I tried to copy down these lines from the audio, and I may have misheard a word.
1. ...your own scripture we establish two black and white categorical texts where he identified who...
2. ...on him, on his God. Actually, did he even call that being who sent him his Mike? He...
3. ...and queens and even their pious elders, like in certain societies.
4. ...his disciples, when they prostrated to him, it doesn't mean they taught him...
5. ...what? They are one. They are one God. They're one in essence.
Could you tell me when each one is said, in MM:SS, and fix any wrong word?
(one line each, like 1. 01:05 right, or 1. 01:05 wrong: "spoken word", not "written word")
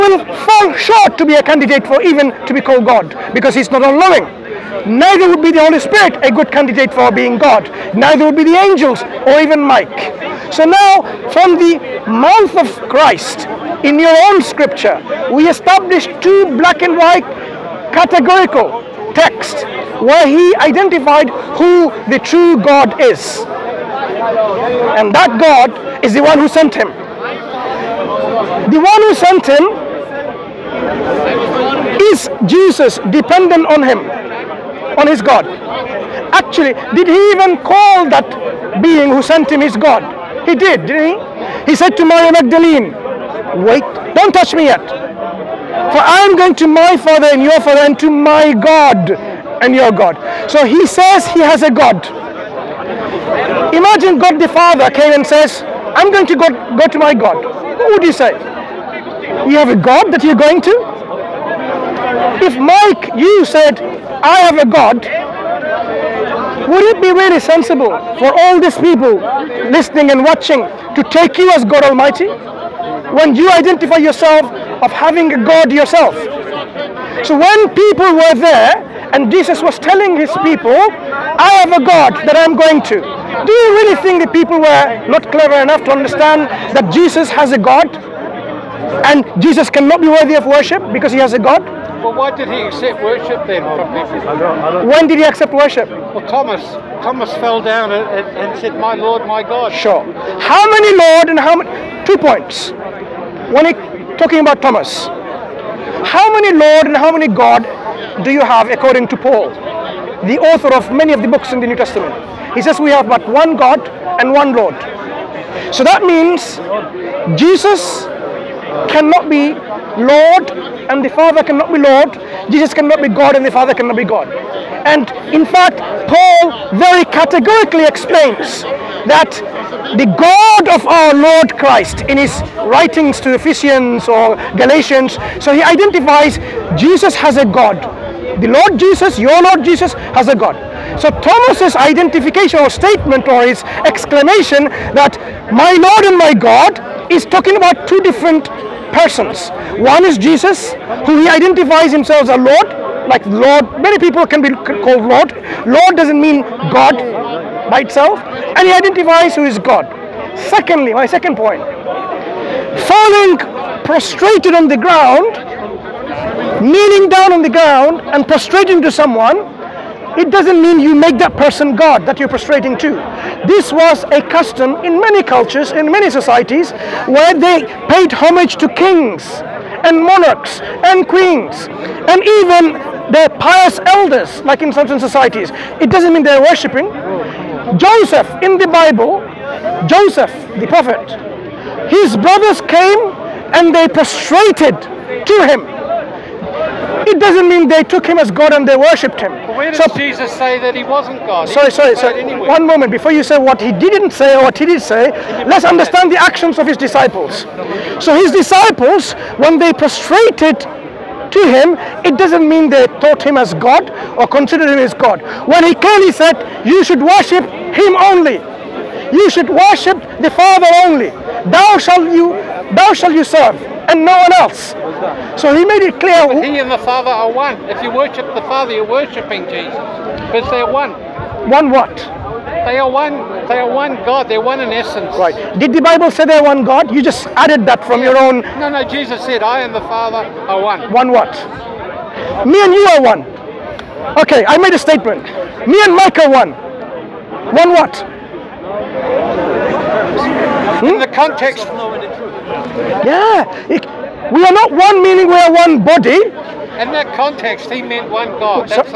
1. 00:13 right
2. 00:33 wrong: "God", not "Mike"
3. 03:00 right
4. 03:28 right
5. 03:51 right.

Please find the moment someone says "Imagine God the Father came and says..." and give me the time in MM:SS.
00:53.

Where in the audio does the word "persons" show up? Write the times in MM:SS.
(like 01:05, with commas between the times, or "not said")
02:28, 02:51.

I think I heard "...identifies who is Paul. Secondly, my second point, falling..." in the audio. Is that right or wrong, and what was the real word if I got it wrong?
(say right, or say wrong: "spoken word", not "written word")
wrong: "God", not "Paul".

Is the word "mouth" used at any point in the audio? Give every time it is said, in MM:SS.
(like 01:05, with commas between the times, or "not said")
00:12.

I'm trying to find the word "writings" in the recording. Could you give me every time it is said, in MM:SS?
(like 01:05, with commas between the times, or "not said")
02:12.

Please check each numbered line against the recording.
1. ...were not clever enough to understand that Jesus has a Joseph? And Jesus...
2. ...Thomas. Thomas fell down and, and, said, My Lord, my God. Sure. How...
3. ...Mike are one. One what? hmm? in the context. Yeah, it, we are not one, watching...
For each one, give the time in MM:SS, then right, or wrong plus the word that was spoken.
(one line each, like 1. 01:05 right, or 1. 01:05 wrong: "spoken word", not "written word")
1. 01:24 wrong: "God", not "Joseph"
2. 01:36 right
3. 04:05 wrong: "meaning", not "watching".